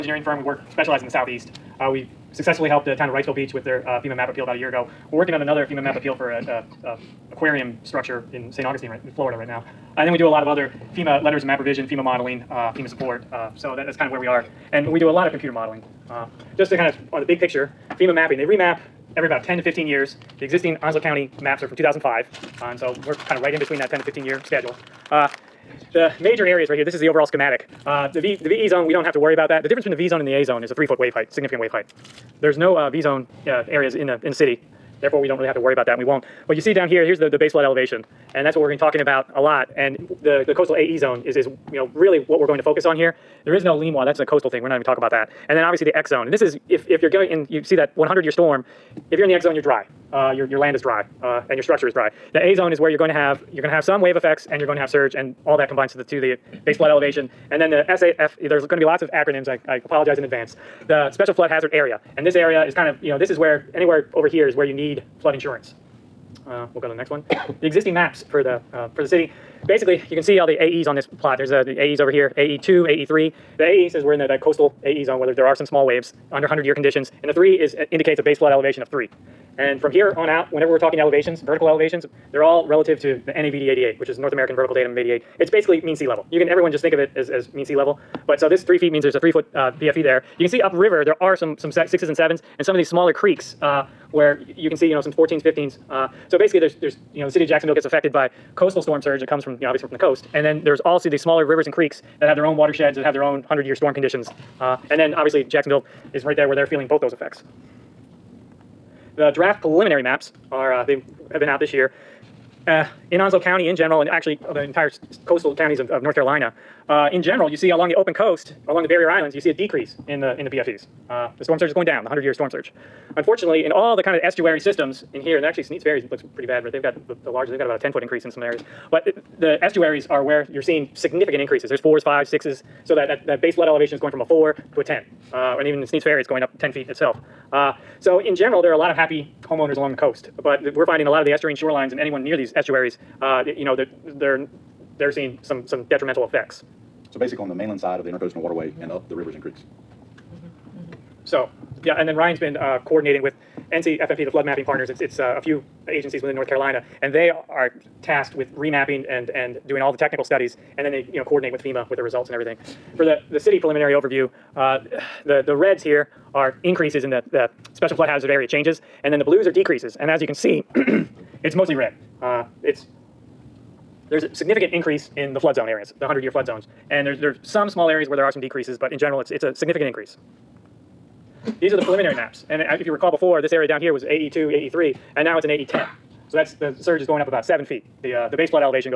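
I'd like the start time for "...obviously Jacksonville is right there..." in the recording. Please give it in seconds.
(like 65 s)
105 s.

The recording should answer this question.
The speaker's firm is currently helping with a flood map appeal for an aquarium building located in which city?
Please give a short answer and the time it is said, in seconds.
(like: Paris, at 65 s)
St. Augustine, at 8 s.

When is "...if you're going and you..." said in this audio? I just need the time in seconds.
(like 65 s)
46 s.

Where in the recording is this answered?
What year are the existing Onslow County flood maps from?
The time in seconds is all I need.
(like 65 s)
21 s.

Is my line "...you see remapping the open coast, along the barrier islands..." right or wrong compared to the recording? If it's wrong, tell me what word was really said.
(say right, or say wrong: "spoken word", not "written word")
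wrong: "along", not "remapping".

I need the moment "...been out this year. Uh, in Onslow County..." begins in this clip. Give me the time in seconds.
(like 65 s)
111 s.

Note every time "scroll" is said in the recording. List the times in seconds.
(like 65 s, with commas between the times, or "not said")
not said.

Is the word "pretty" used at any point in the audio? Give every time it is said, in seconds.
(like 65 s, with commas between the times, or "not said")
126 s.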